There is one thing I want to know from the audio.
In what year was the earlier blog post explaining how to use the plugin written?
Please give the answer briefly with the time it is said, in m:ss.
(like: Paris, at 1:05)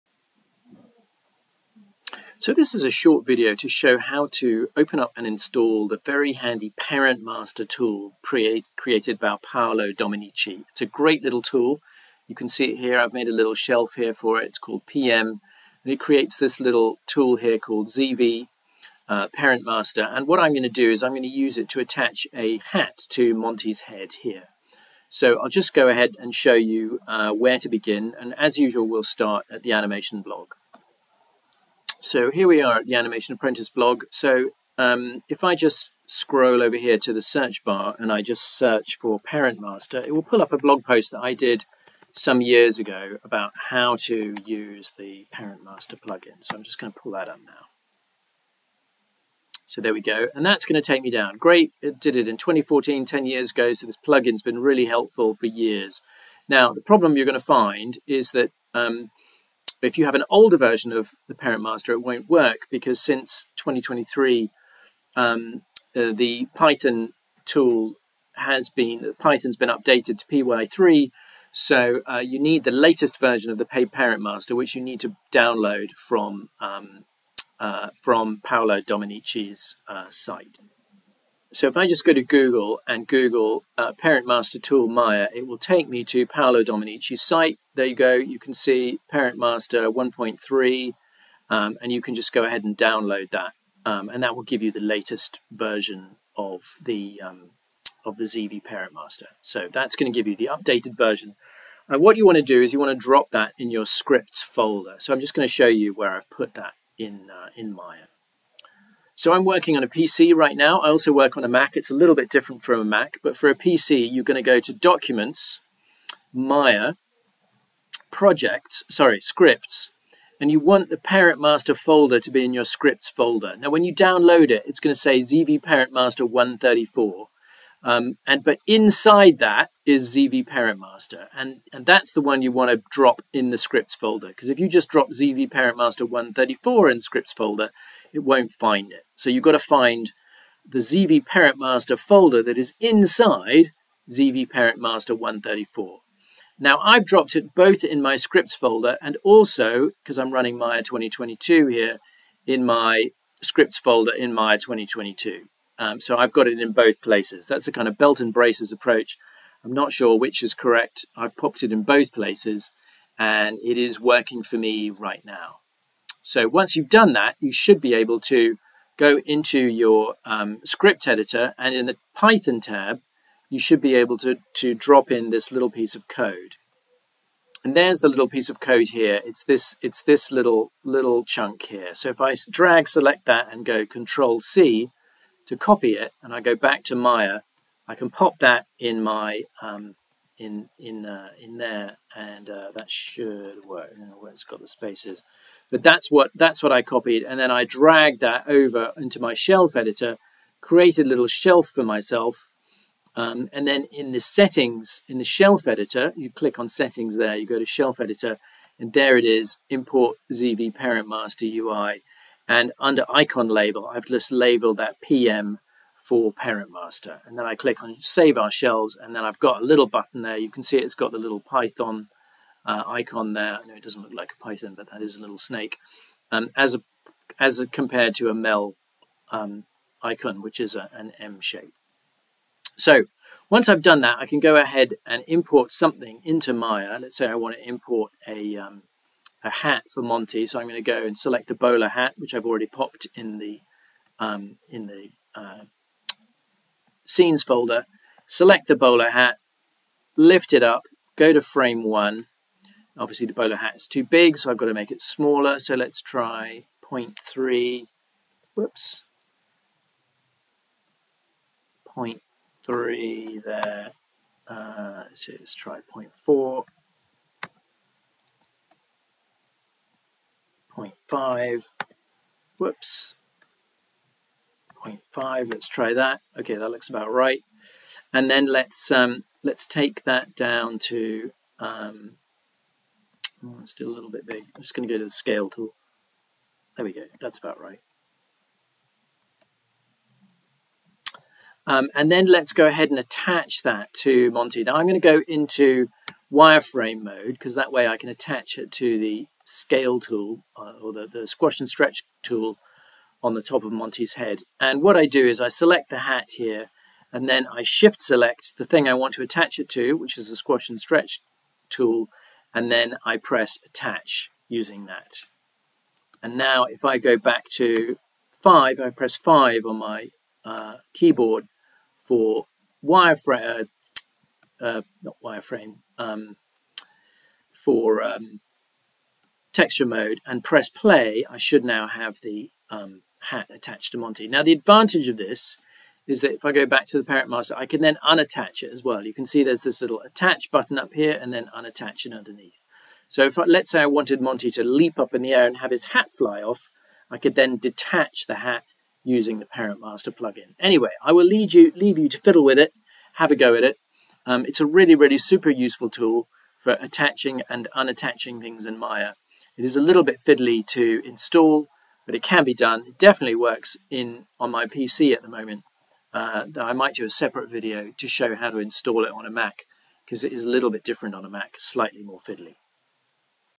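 2014, at 0:52.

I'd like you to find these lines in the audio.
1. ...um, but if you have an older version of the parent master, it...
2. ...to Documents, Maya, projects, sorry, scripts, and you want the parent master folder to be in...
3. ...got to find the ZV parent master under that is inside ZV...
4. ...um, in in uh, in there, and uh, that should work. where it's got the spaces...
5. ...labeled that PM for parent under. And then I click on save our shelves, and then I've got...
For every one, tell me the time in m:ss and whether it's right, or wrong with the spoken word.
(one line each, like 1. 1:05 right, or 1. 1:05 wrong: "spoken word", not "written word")
1. 0:58 right
2. 1:54 right
3. 2:19 wrong: "folder", not "under"
4. 3:09 right
5. 3:34 wrong: "master", not "under".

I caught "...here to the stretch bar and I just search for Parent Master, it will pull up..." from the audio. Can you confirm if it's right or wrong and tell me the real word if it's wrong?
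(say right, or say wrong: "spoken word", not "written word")
wrong: "search", not "stretch".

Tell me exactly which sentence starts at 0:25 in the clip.
So I'll just go ahead and show you uh, where to begin.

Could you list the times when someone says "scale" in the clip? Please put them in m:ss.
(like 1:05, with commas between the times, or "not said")
4:45, 4:59.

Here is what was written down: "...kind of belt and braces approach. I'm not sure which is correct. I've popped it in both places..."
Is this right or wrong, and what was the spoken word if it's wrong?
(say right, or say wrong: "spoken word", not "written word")
right.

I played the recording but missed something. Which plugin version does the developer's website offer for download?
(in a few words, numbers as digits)
1.3.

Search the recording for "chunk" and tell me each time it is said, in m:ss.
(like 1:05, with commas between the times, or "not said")
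3:01.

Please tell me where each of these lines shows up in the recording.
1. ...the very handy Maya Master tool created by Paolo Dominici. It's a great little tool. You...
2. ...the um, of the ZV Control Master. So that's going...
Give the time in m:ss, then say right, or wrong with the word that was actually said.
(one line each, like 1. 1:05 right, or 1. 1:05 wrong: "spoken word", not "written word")
1. 0:05 wrong: "Parent", not "Maya"
2. 1:36 wrong: "Parent", not "Control".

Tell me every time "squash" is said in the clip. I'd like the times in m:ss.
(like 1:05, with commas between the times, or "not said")
5:01, 5:10.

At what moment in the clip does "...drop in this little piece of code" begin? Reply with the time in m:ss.
2:54.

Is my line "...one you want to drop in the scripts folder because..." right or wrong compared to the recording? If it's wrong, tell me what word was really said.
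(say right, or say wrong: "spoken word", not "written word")
right.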